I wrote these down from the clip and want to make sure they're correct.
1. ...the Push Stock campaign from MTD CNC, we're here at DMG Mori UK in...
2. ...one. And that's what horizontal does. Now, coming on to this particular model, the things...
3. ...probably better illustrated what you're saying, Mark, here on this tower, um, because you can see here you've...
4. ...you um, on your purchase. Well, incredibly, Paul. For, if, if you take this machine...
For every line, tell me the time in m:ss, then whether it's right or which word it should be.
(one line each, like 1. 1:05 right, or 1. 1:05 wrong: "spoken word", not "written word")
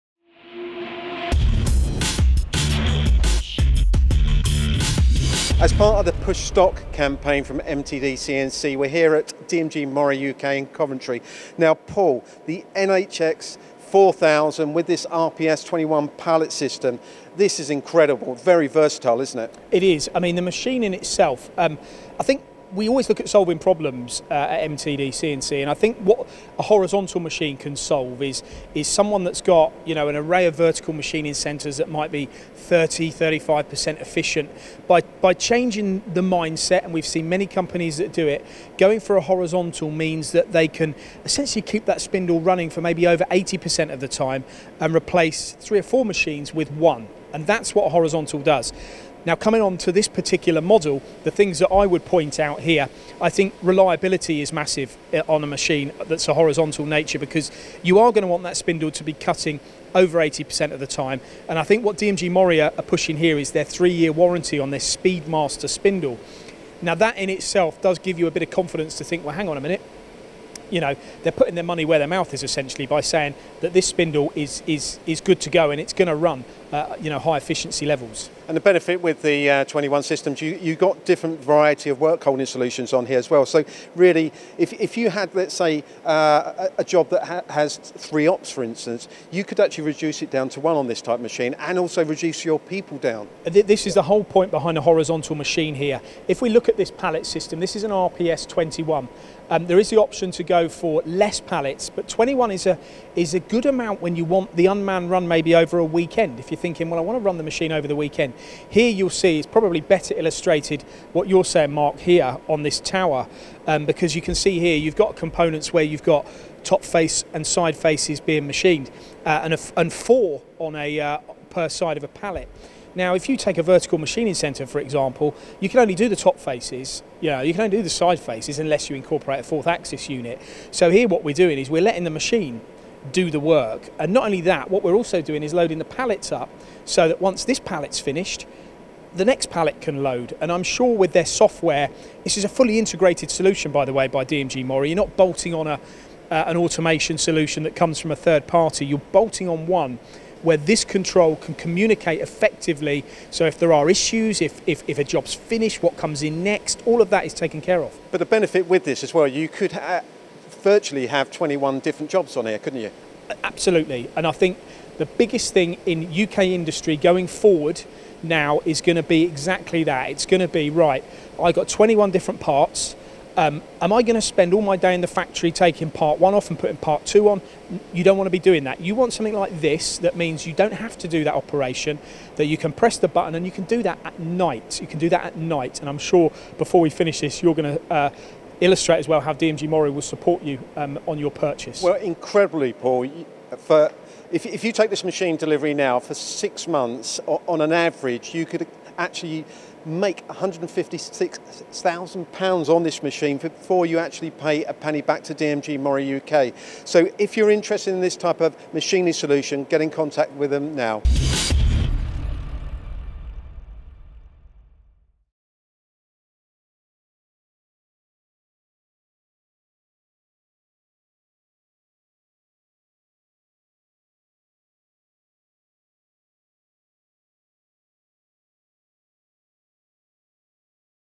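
1. 0:06 right
2. 0:46 right
3. 1:49 right
4. 3:10 right.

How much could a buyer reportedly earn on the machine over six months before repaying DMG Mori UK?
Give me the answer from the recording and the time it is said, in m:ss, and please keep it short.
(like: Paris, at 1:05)
£156,000, at 3:20.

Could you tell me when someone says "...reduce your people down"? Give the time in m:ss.
1:32.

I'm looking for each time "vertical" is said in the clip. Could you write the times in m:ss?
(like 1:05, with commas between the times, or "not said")
0:30, 2:03.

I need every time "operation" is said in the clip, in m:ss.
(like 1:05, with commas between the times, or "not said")
3:01.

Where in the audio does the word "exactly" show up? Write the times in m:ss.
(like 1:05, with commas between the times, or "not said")
2:49.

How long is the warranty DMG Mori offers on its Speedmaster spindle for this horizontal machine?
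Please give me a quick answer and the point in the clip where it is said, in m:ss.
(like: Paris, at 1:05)
3 years, at 1:03.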